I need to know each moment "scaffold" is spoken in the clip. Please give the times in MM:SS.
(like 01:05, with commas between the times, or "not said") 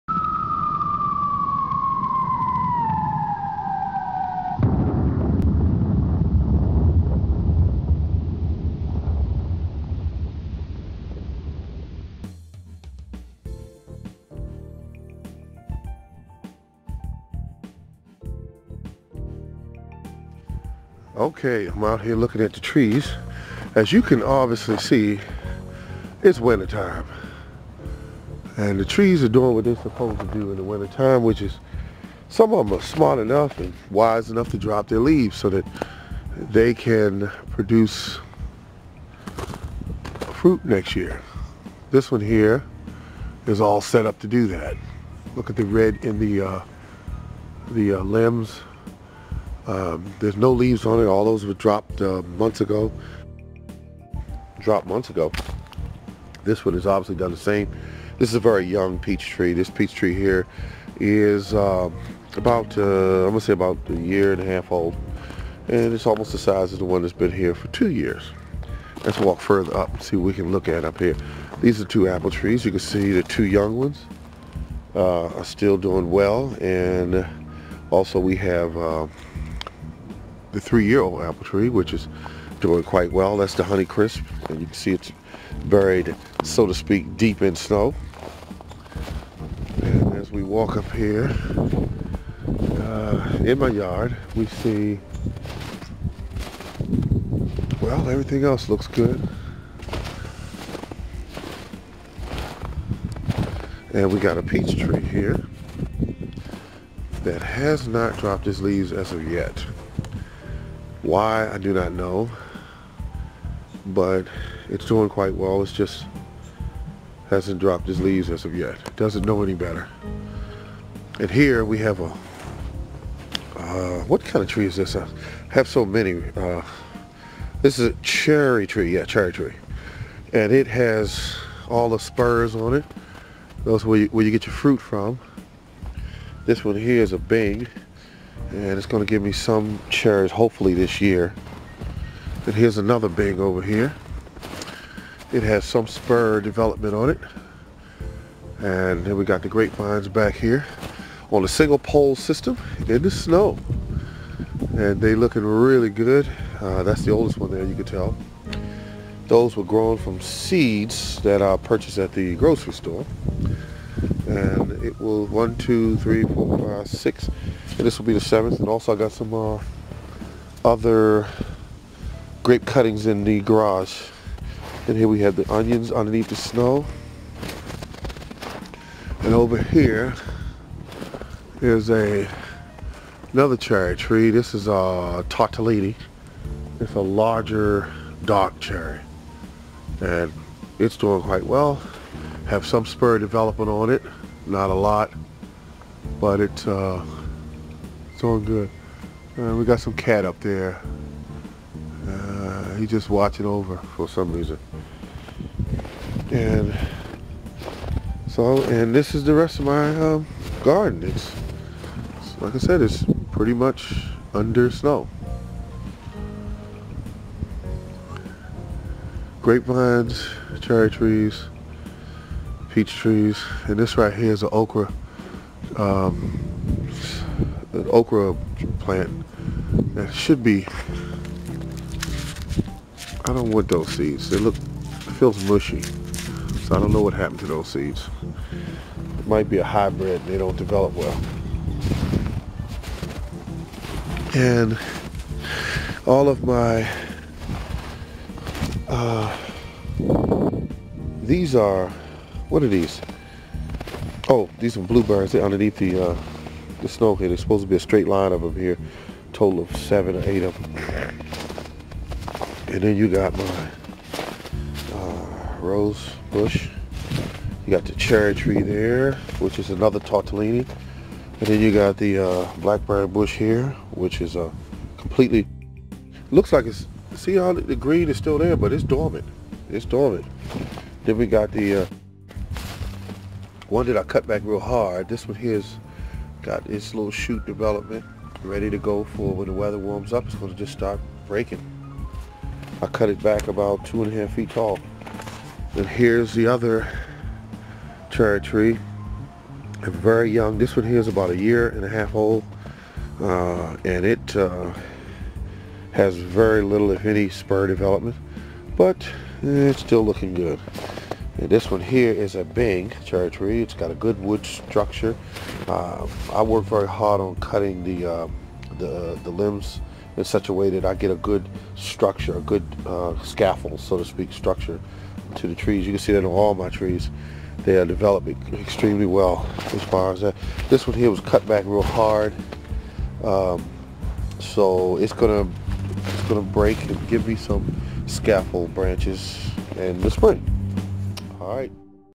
05:23, 05:38.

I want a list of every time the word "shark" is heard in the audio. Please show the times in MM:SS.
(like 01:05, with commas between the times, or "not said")
not said.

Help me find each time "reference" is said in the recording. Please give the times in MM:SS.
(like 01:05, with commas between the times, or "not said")
not said.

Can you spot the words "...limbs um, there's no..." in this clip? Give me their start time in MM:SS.
00:47.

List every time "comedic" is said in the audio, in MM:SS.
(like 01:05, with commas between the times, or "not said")
not said.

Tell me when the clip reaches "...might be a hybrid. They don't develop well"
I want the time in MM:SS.
03:59.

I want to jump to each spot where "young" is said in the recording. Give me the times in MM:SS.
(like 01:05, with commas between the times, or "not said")
00:58, 01:13, 05:00.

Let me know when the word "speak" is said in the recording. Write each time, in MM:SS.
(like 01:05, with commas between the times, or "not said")
01:26, 05:24.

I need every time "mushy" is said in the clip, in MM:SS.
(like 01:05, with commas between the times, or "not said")
03:55.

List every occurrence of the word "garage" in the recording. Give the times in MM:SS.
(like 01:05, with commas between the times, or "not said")
02:53.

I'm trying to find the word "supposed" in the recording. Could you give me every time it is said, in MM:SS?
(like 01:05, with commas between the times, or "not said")
00:29, 04:17.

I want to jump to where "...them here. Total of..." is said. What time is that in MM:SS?
04:18.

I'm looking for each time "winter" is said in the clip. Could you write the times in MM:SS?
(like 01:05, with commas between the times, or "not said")
00:26, 00:30.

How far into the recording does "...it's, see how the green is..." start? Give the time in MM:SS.
04:36.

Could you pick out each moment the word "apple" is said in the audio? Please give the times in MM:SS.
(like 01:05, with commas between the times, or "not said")
01:12, 01:21.